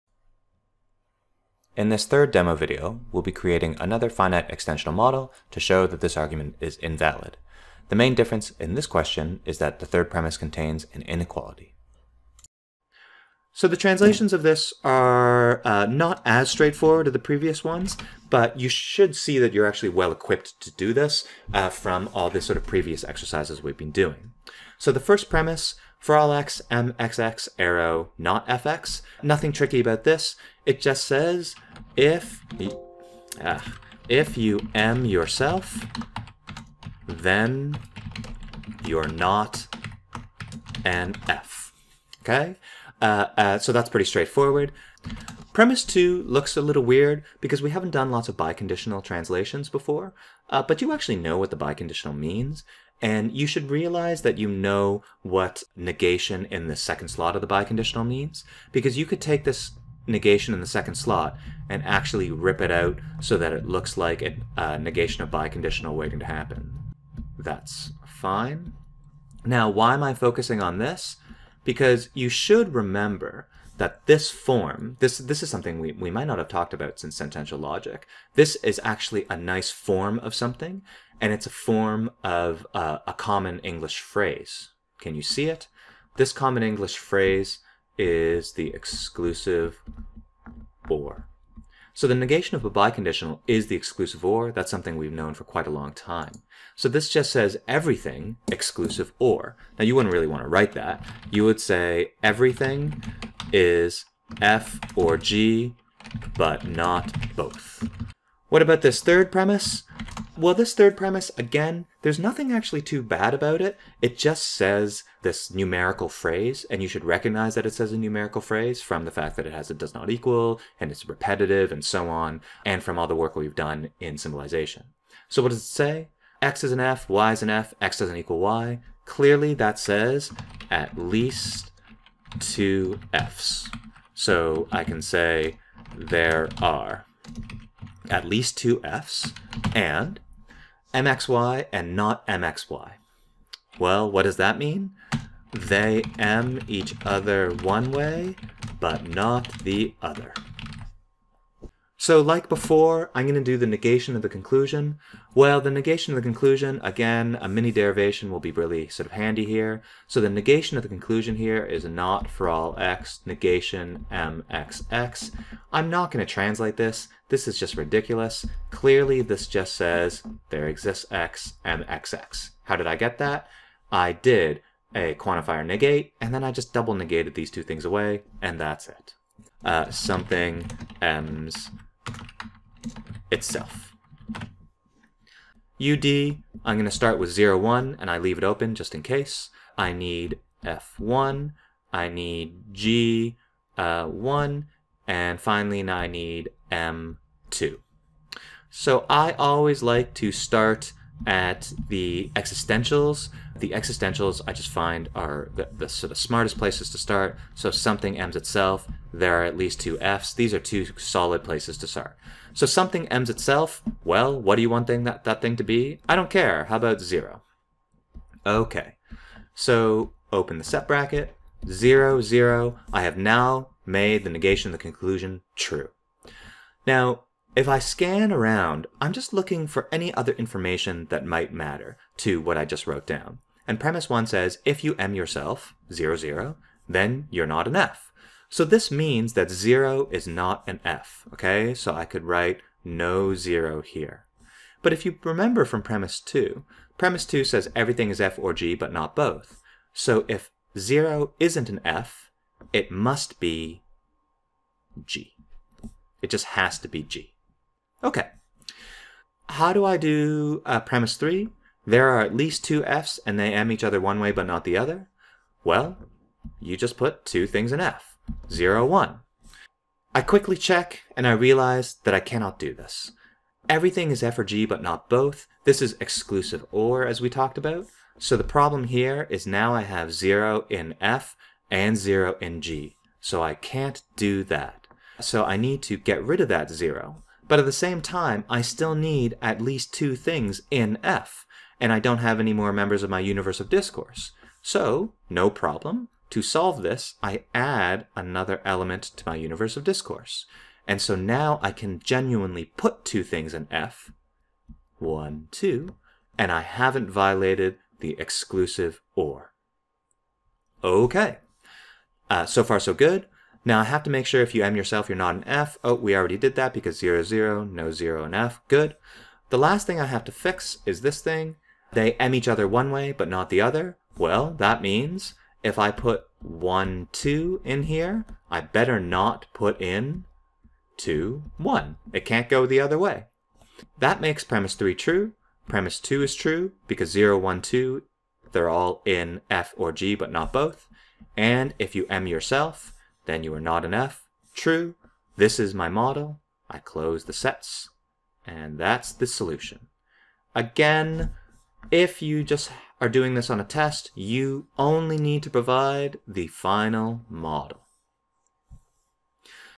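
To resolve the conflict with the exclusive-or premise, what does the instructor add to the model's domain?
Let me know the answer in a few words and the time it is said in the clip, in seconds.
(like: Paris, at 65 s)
another element, at 298 s.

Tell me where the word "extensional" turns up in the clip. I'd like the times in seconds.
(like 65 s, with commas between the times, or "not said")
4 s.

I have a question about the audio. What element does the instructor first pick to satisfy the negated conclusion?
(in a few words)
0.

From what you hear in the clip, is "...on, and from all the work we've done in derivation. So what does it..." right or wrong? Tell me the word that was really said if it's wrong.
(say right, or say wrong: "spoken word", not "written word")
wrong: "symbolization", not "derivation".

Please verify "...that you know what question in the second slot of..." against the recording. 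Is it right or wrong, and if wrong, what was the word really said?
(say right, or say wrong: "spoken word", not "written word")
wrong: "negation", not "question".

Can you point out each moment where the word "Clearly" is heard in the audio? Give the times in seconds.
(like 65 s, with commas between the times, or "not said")
129 s, 168 s.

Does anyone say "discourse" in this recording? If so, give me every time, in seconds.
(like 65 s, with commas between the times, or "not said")
293 s, 299 s.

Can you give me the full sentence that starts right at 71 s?
Because you should remember that this form, this, this is something we, we might not have talked about since sentential logic.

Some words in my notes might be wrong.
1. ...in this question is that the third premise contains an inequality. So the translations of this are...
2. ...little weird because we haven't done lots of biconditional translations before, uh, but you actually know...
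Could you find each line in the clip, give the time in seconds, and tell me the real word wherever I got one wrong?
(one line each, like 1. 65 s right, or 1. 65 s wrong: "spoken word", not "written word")
1. 8 s right
2. 46 s right.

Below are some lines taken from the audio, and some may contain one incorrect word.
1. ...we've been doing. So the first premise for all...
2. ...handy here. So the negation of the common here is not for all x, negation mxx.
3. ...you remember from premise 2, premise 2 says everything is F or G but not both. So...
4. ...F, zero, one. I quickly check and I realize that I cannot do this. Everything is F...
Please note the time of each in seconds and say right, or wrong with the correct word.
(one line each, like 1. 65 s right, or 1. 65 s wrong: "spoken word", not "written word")
1. 23 s right
2. 159 s wrong: "conclusion", not "common"
3. 245 s right
4. 267 s right.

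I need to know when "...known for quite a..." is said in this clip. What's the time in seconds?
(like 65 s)
95 s.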